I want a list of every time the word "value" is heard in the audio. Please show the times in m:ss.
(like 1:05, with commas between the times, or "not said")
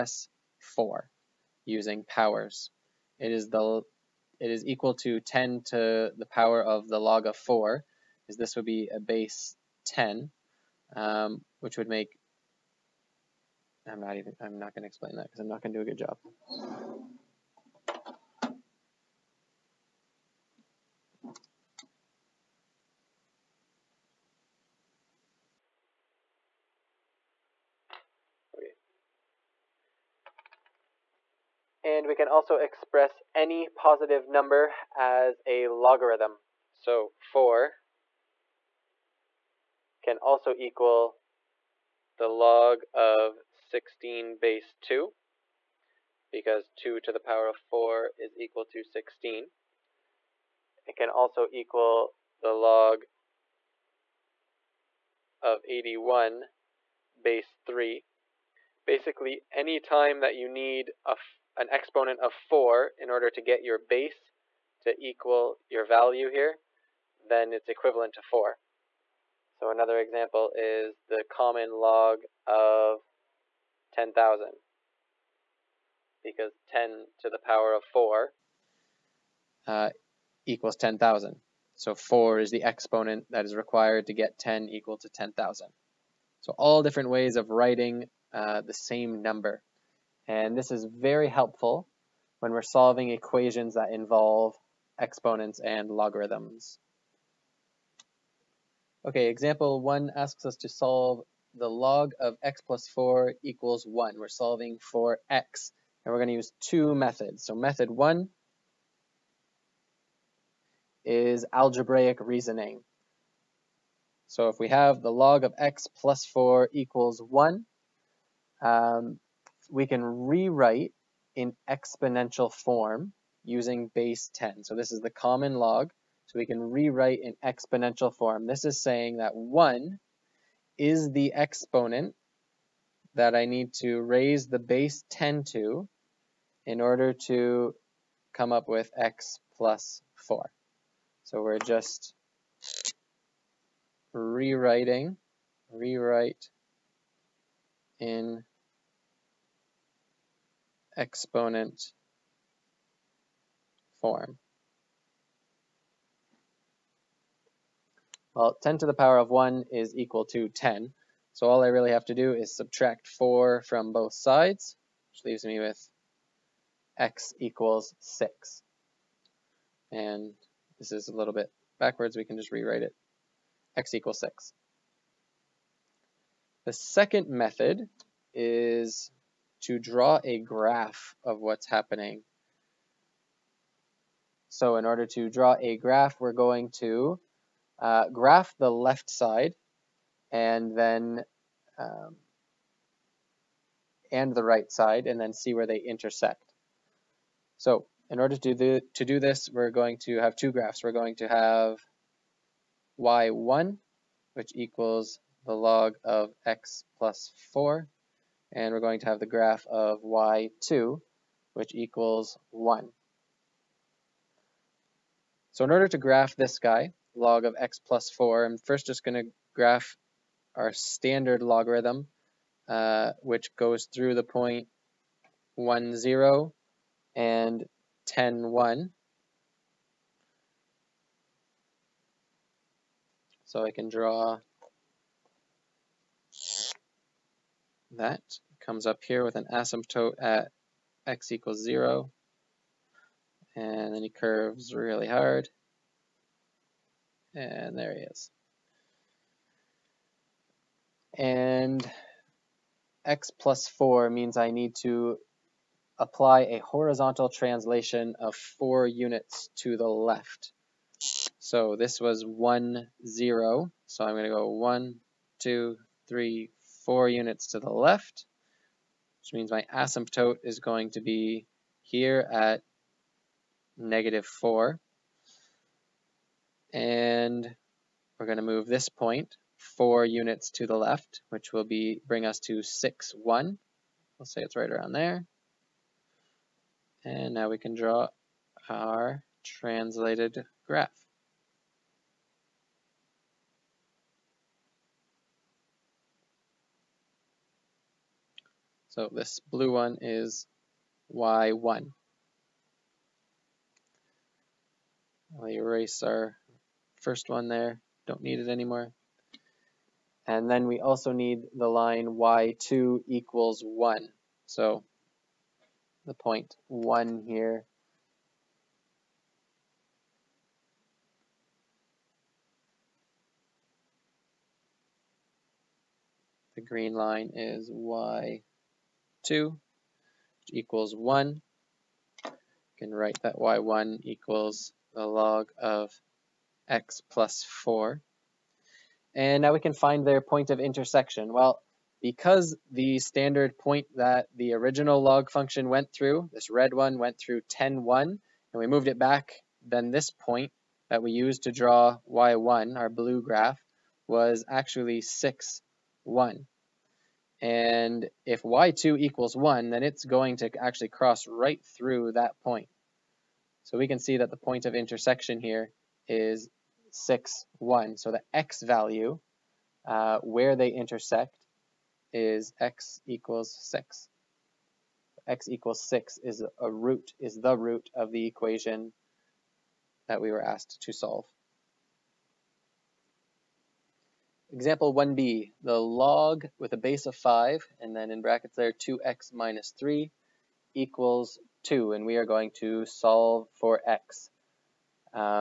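1:05, 6:08.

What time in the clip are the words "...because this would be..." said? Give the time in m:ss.
0:08.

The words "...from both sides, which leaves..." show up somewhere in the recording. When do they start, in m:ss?
2:43.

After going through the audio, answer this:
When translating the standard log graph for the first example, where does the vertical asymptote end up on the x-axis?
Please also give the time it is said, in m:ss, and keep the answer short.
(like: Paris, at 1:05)
-4, at 4:33.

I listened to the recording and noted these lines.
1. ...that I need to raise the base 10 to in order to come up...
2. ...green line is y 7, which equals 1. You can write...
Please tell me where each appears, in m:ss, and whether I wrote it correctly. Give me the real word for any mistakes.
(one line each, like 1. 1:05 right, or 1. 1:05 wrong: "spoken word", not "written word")
1. 2:13 right
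2. 5:26 wrong: "2", not "7".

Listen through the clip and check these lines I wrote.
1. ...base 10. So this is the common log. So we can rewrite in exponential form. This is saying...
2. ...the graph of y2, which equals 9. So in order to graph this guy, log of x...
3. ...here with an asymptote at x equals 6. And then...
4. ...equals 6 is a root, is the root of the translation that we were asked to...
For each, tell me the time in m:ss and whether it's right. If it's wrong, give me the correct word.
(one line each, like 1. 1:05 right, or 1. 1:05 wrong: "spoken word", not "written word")
1. 2:03 right
2. 3:29 wrong: "1", not "9"
3. 3:59 wrong: "0", not "6"
4. 6:15 wrong: "equation", not "translation".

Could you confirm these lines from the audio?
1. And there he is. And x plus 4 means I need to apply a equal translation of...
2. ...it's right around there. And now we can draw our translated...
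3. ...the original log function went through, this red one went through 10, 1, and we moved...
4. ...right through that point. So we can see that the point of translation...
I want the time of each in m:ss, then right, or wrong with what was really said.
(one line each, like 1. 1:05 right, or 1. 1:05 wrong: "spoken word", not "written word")
1. 4:07 wrong: "horizontal", not "equal"
2. 4:44 right
3. 5:44 right
4. 6:01 wrong: "intersection", not "translation".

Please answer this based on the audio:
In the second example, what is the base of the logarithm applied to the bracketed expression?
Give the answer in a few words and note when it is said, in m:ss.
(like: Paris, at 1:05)
5, at 6:26.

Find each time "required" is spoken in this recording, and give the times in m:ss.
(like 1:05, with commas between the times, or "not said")
1:23.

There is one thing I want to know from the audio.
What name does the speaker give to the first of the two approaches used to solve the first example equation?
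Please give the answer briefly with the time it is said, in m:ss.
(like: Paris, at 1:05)
algebraic reasoning, at 1:51.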